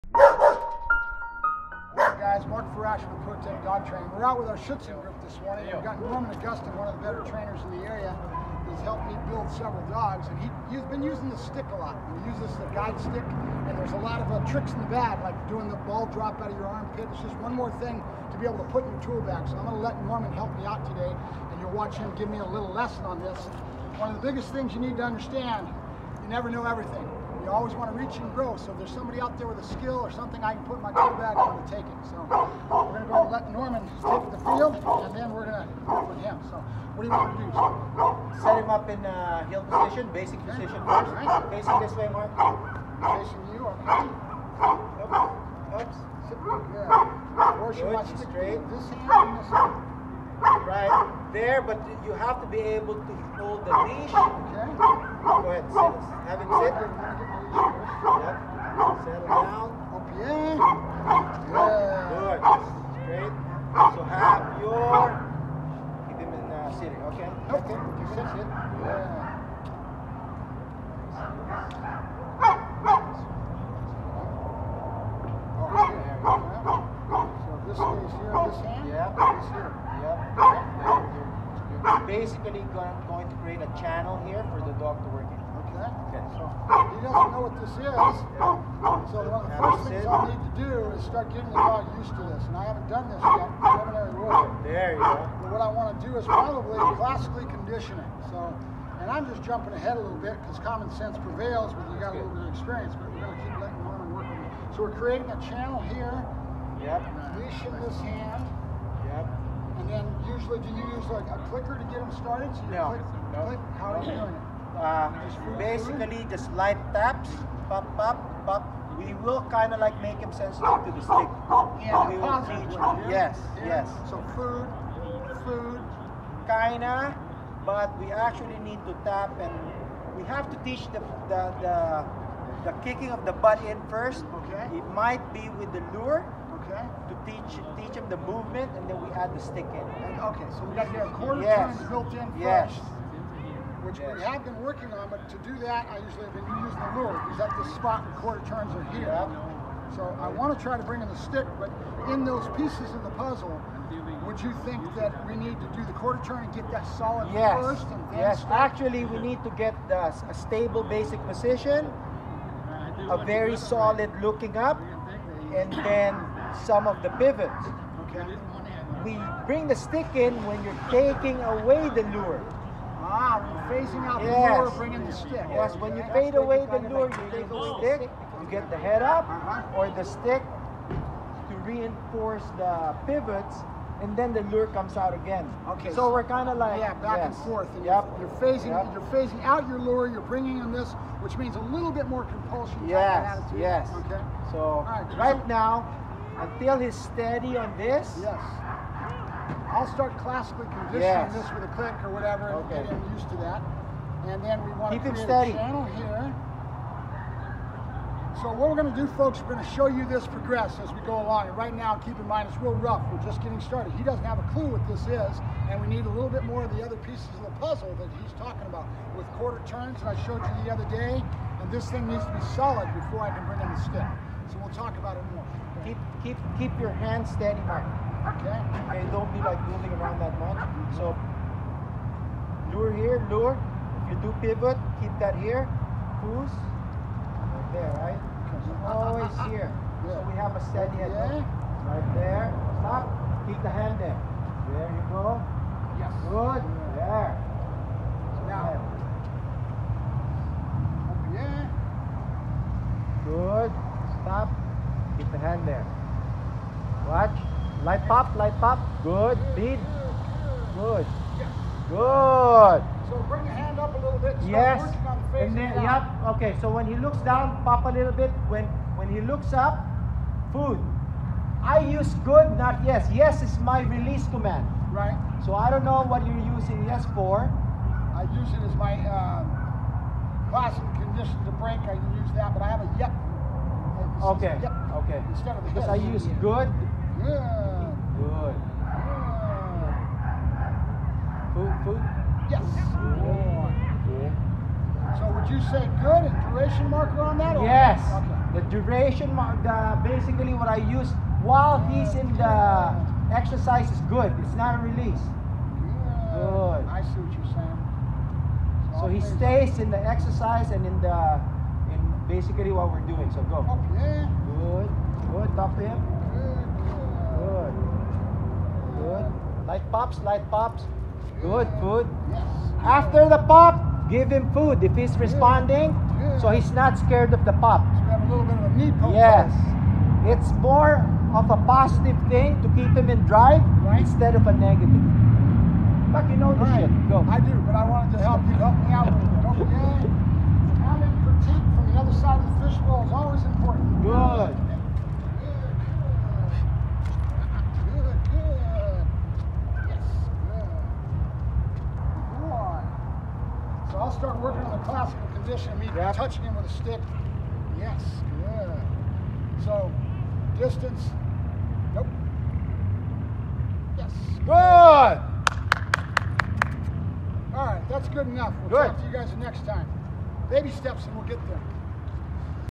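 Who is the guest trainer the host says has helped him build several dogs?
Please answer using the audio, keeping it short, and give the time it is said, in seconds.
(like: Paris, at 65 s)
Norman Augustin, at 6 s.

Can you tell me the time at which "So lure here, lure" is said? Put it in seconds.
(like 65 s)
230 s.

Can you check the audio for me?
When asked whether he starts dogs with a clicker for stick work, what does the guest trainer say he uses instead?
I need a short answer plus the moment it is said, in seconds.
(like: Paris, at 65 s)
Light taps, at 116 s.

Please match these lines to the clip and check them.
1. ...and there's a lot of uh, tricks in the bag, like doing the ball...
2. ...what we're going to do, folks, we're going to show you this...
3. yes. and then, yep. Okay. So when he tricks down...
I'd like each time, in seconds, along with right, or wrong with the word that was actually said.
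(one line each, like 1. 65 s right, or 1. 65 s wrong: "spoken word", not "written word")
1. 13 s right
2. 208 s right
3. 264 s wrong: "looks", not "tricks".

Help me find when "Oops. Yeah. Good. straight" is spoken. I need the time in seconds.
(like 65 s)
45 s.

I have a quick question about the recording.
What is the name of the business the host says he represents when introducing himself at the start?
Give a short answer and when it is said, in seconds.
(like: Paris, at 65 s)
Pro Dog Training, at 3 s.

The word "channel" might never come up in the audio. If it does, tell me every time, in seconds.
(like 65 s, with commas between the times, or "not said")
83 s, 105 s, 205 s.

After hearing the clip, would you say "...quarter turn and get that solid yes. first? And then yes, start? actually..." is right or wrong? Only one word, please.
right.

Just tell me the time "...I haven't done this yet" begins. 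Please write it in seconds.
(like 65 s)
92 s.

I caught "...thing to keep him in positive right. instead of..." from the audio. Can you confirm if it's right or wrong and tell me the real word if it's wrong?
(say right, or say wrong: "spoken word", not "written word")
wrong: "drive", not "positive".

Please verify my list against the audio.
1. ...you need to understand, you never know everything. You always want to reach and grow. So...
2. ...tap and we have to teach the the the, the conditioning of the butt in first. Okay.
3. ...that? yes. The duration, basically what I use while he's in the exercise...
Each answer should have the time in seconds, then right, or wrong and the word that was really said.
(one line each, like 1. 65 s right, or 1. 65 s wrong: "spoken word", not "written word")
1. 24 s right
2. 129 s wrong: "kicking", not "conditioning"
3. 297 s right.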